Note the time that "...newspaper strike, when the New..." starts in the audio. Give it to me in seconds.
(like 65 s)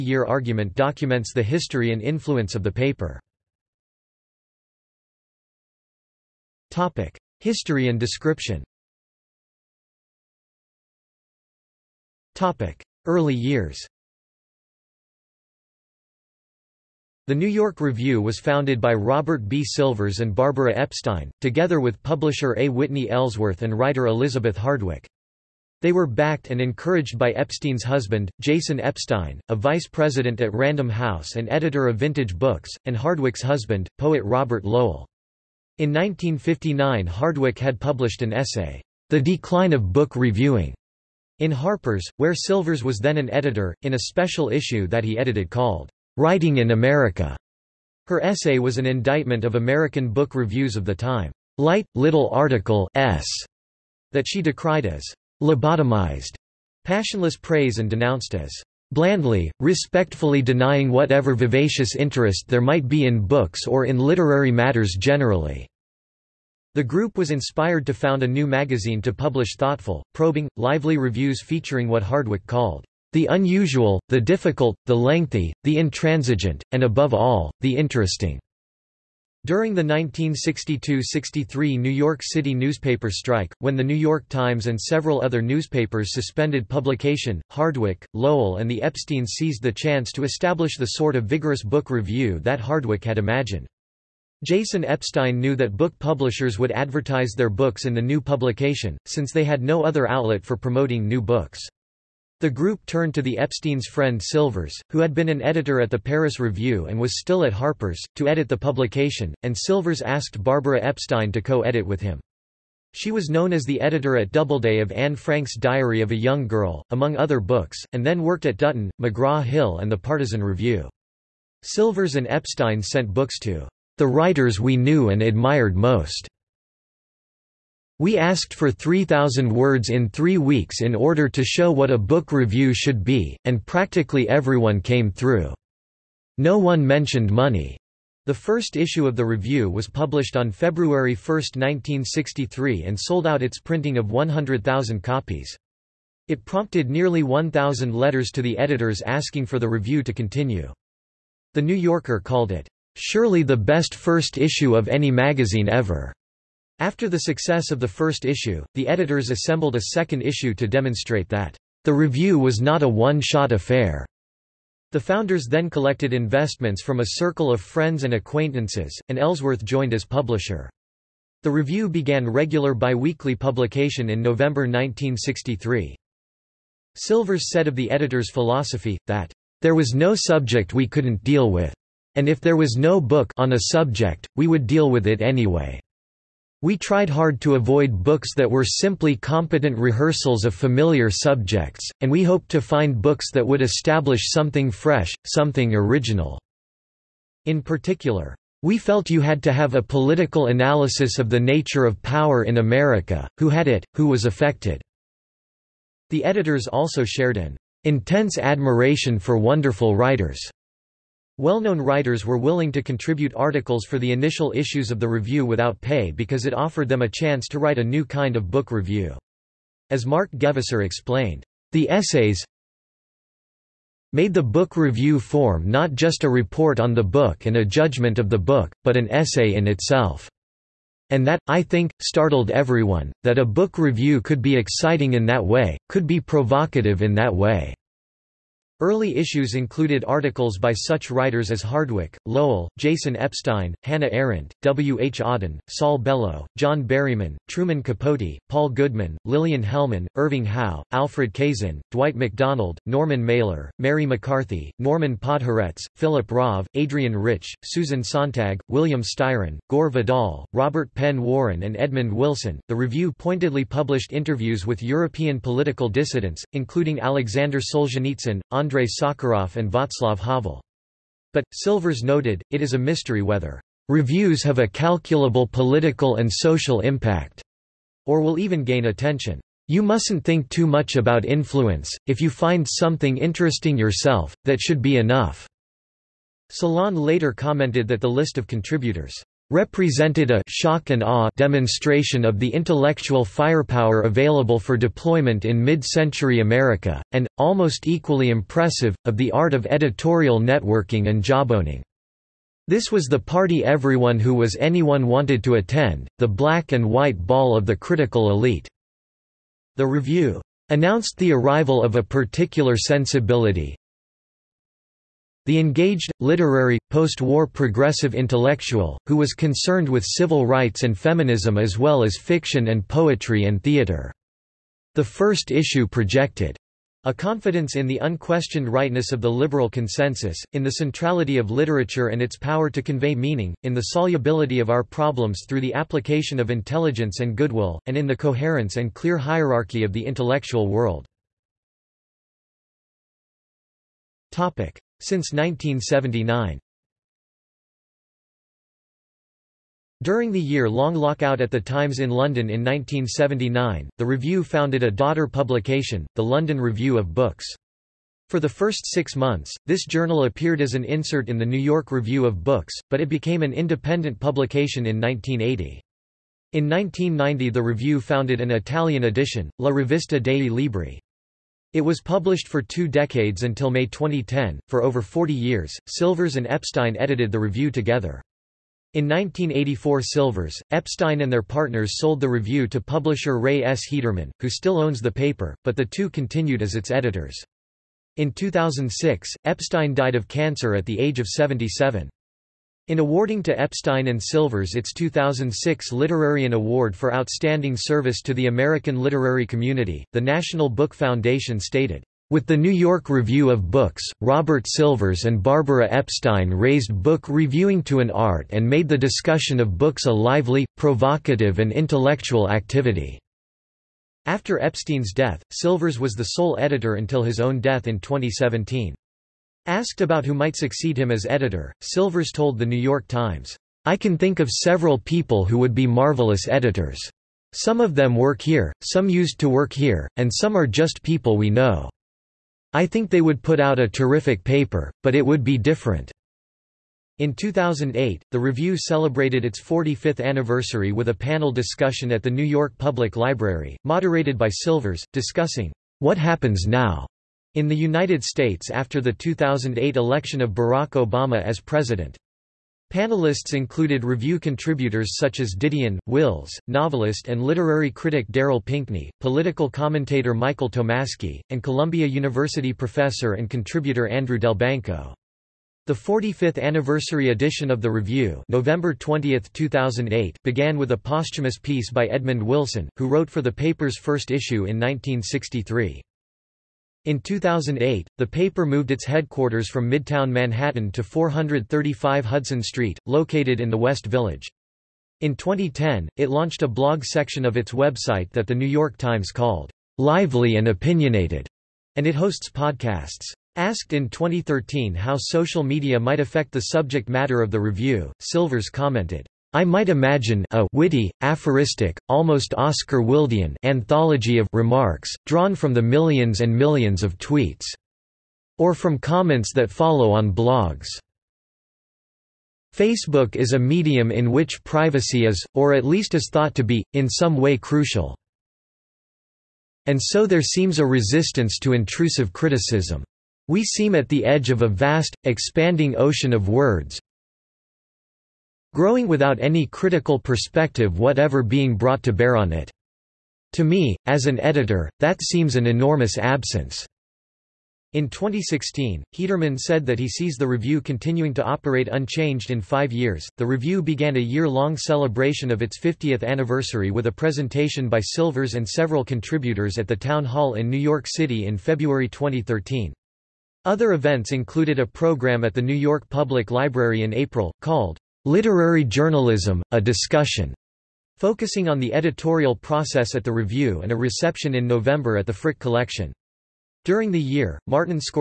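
82 s.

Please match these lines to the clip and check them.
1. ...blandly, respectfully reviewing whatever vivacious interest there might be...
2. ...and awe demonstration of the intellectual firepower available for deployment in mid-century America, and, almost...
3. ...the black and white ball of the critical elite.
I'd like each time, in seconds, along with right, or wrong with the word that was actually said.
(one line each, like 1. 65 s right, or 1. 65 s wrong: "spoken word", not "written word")
1. 58 s wrong: "denying", not "reviewing"
2. 290 s right
3. 306 s right.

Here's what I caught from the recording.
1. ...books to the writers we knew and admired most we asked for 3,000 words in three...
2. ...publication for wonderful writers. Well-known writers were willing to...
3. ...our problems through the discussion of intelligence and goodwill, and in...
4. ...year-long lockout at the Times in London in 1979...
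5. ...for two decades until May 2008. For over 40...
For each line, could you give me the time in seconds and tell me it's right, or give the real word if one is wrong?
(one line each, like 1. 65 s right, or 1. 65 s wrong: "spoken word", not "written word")
1. 123 s right
2. 208 s wrong: "admiration", not "publication"
3. 334 s wrong: "application", not "discussion"
4. 350 s right
5. 372 s wrong: "2010", not "2008".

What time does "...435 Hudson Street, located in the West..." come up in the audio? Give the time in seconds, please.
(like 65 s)
481 s.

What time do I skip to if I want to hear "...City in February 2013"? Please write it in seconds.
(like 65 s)
551 s.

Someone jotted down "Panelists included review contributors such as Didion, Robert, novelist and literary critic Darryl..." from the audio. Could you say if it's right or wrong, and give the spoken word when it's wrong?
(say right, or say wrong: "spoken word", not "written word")
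wrong: "Wills", not "Robert".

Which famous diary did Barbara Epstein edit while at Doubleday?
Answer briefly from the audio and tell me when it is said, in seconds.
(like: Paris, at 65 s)
Anne Frank's Diary of a Young Girl, at 114 s.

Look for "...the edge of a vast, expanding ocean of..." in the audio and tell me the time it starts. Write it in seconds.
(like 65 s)
524 s.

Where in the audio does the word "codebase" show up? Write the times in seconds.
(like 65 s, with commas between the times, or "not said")
not said.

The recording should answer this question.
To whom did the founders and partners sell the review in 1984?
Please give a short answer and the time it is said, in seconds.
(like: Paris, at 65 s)
Ray S. Hederman, at 383 s.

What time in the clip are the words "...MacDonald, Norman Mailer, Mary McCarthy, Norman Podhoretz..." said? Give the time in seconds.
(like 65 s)
252 s.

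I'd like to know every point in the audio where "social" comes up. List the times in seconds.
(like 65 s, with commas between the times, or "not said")
276 s, 495 s.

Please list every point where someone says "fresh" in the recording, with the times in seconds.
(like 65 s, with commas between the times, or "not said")
194 s.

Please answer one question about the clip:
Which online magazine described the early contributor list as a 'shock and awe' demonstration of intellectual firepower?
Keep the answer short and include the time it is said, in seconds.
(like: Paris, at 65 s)
Salon, at 286 s.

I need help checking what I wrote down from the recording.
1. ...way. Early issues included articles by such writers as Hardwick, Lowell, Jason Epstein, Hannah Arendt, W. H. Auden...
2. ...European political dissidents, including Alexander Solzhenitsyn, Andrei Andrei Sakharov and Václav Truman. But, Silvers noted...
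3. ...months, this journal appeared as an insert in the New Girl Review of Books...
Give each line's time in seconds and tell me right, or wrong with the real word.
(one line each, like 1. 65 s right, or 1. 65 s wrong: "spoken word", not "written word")
1. 237 s right
2. 264 s wrong: "Havel", not "Truman"
3. 359 s wrong: "York", not "Girl".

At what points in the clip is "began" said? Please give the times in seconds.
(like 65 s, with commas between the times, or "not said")
171 s, 470 s, 543 s.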